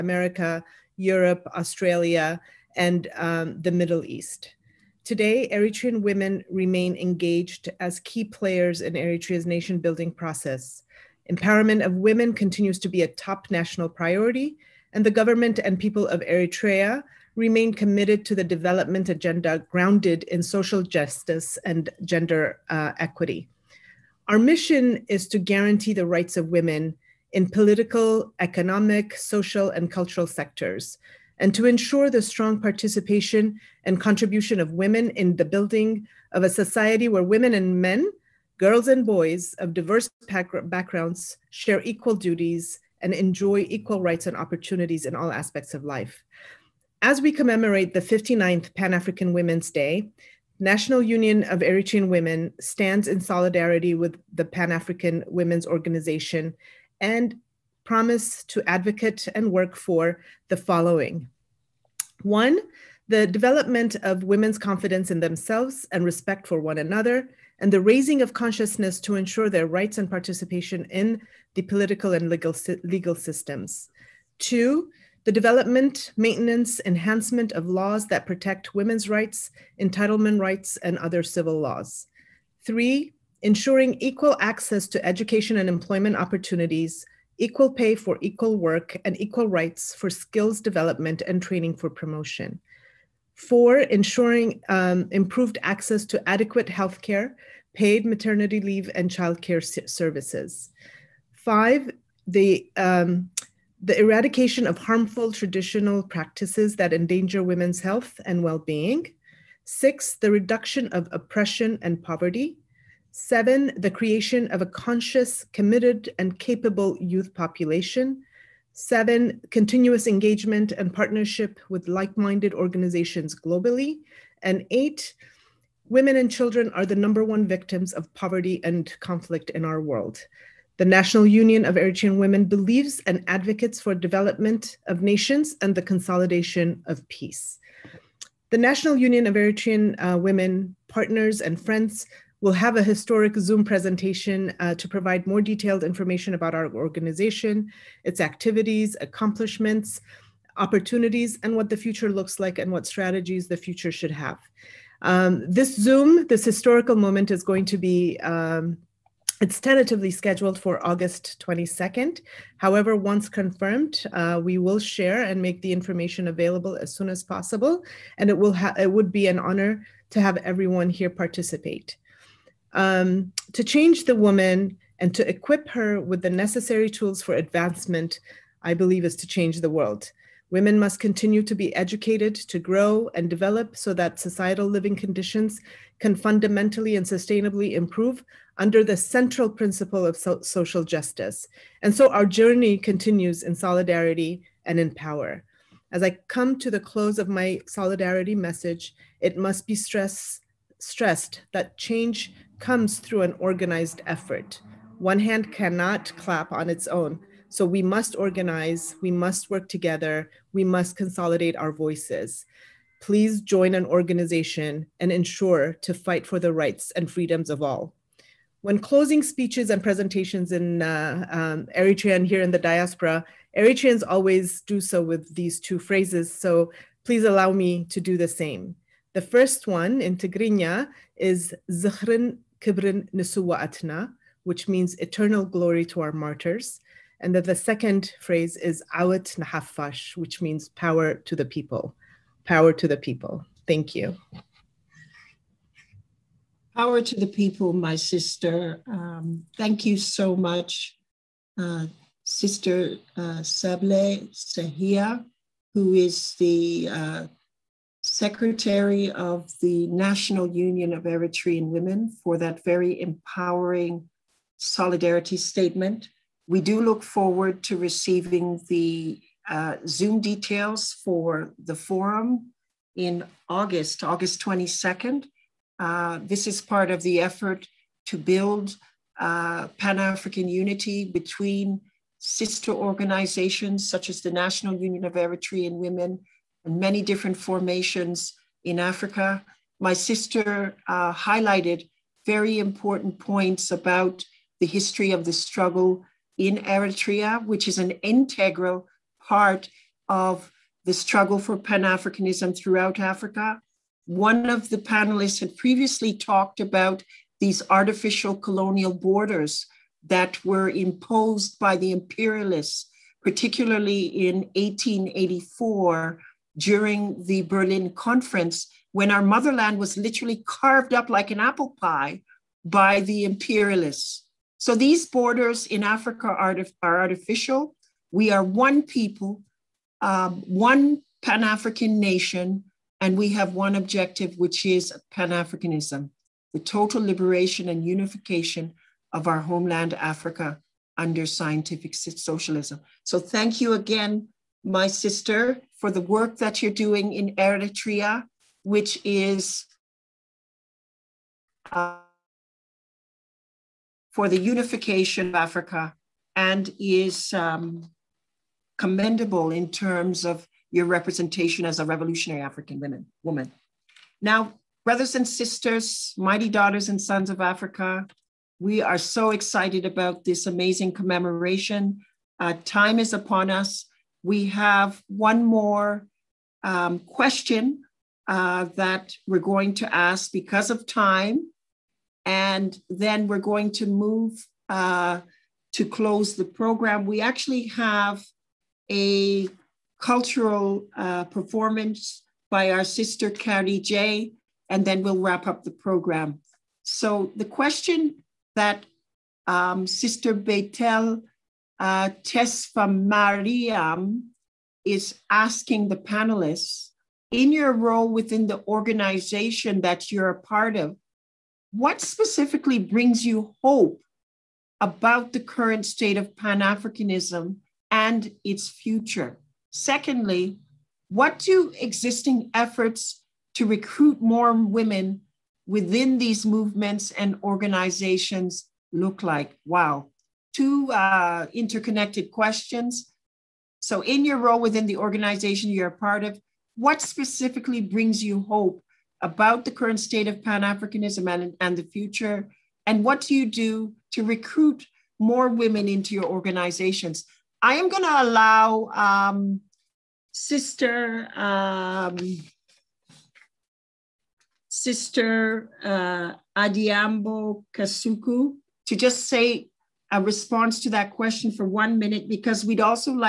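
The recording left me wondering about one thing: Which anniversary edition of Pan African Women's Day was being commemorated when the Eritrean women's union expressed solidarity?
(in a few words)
59th.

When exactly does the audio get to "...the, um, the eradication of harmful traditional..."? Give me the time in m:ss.
1:42.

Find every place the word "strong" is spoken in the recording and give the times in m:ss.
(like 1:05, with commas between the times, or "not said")
0:32.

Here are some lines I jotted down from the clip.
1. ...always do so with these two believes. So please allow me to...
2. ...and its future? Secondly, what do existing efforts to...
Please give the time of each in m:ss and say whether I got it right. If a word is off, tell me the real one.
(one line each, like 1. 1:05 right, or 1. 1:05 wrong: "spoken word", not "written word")
1. 3:44 wrong: "phrases", not "believes"
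2. 6:57 right.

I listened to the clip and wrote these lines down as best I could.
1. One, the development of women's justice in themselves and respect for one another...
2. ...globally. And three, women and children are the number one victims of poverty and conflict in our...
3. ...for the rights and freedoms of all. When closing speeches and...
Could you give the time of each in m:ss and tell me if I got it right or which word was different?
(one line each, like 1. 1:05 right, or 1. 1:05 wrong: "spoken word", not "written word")
1. 1:02 wrong: "confidence", not "justice"
2. 2:03 wrong: "eight", not "three"
3. 3:36 right.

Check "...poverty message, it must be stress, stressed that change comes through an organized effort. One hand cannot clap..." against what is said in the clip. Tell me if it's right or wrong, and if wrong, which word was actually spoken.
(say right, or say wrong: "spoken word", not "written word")
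wrong: "solidarity", not "poverty".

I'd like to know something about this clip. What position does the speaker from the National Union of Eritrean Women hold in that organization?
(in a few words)
Secretary.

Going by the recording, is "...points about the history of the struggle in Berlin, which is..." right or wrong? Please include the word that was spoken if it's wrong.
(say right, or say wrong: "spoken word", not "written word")
wrong: "Eritrea", not "Berlin".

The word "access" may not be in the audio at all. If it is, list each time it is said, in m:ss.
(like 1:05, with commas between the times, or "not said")
1:24, 1:35.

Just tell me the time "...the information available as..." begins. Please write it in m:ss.
2:45.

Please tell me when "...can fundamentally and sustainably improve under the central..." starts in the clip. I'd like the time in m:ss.
3:05.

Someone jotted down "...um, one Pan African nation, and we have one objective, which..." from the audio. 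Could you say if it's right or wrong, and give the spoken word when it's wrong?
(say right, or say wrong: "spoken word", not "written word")
right.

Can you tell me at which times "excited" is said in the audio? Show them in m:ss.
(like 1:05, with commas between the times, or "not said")
6:09.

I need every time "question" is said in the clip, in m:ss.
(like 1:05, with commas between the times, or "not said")
6:16, 6:37, 7:12, 7:41.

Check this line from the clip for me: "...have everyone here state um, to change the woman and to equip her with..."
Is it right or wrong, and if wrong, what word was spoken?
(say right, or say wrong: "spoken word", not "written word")
wrong: "participate", not "state".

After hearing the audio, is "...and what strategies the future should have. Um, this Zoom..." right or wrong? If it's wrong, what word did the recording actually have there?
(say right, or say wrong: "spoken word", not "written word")
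right.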